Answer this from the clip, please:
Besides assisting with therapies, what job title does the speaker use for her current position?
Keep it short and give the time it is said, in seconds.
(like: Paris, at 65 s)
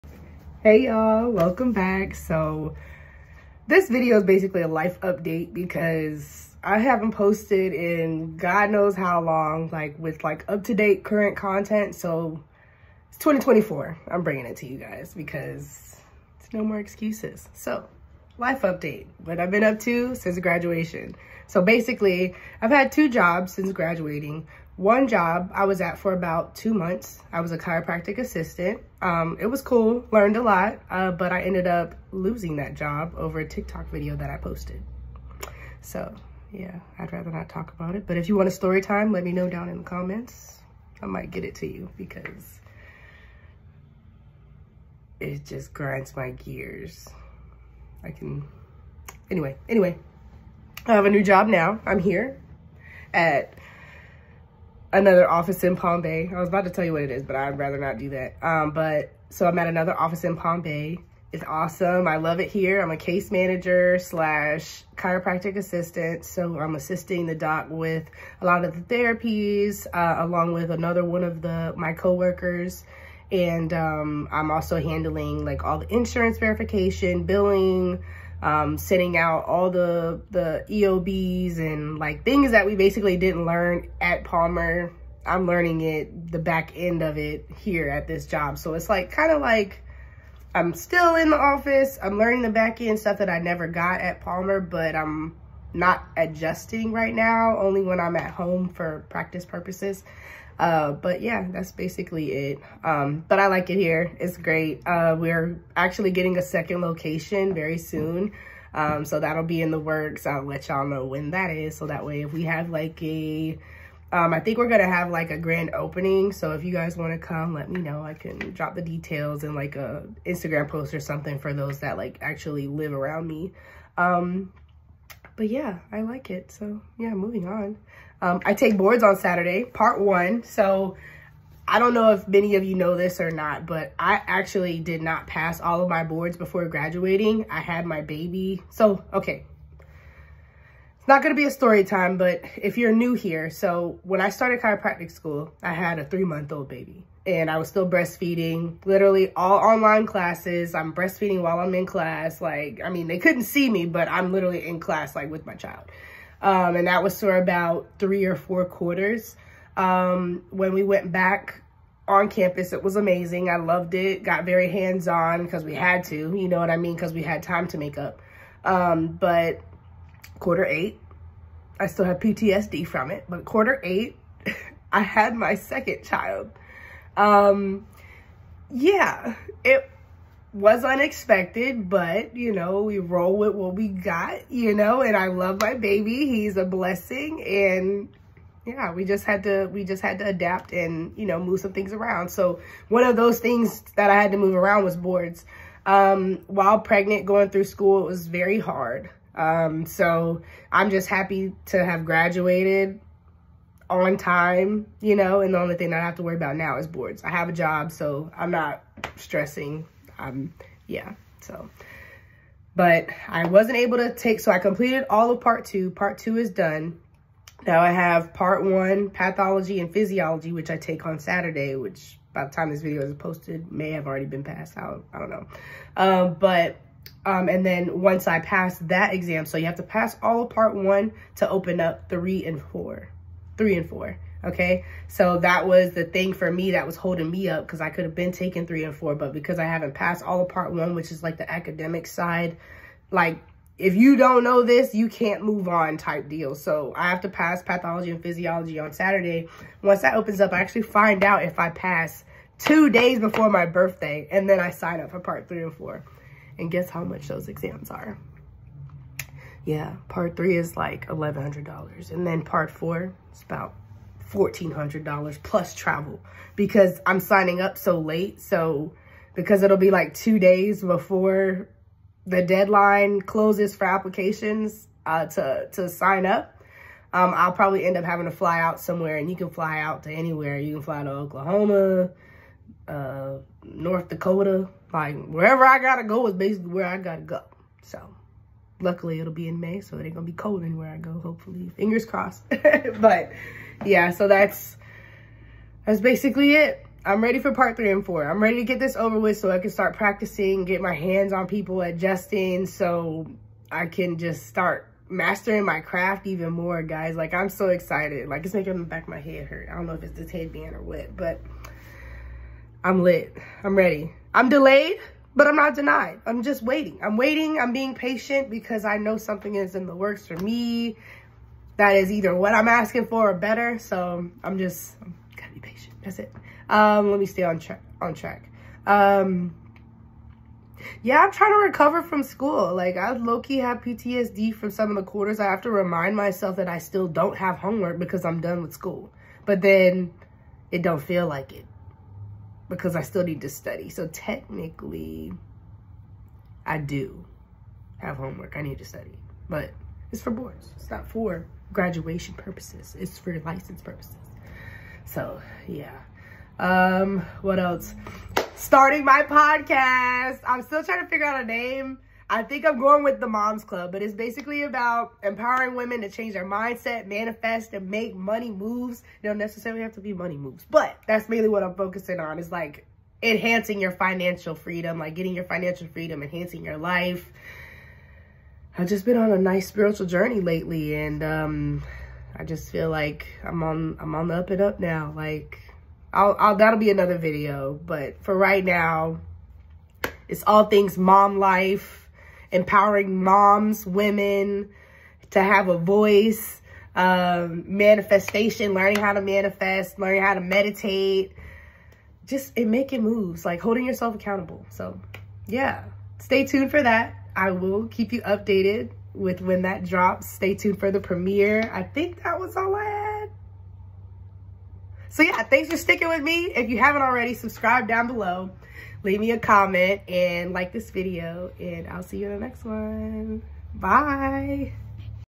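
Case manager, at 62 s.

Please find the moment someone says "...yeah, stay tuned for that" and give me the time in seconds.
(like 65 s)
405 s.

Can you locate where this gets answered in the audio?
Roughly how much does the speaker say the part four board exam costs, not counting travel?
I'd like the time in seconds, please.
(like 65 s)
264 s.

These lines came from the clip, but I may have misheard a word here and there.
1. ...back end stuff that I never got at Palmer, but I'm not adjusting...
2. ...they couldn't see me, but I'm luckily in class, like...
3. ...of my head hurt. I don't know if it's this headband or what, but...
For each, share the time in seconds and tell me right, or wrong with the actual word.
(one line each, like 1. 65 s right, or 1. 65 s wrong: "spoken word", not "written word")
1. 92 s right
2. 153 s wrong: "literally", not "luckily"
3. 309 s right.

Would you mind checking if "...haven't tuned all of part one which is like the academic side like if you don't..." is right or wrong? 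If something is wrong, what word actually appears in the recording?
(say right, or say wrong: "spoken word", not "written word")
wrong: "passed", not "tuned".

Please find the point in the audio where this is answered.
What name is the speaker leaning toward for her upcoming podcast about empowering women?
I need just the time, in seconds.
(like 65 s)
363 s.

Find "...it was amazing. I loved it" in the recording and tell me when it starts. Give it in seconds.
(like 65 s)
162 s.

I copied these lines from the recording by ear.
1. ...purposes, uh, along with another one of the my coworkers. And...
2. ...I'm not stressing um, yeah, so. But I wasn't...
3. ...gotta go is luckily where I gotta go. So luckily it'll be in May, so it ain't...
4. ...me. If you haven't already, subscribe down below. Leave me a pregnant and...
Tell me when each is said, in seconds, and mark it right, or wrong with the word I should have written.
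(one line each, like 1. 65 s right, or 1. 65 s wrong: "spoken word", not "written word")
1. 68 s wrong: "therapies", not "purposes"
2. 208 s right
3. 285 s wrong: "basically", not "luckily"
4. 416 s wrong: "comment", not "pregnant".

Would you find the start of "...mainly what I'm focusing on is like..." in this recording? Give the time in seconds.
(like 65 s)
371 s.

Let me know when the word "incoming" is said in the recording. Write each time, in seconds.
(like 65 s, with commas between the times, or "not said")
not said.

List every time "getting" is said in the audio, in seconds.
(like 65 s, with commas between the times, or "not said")
106 s, 375 s.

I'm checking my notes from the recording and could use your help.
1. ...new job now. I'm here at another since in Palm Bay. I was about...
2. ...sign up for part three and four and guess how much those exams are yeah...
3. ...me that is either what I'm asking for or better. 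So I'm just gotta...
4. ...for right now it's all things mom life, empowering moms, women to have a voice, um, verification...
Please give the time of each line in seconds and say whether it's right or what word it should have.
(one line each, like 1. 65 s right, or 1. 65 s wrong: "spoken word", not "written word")
1. 51 s wrong: "office", not "since"
2. 254 s right
3. 320 s right
4. 388 s wrong: "manifestation", not "verification".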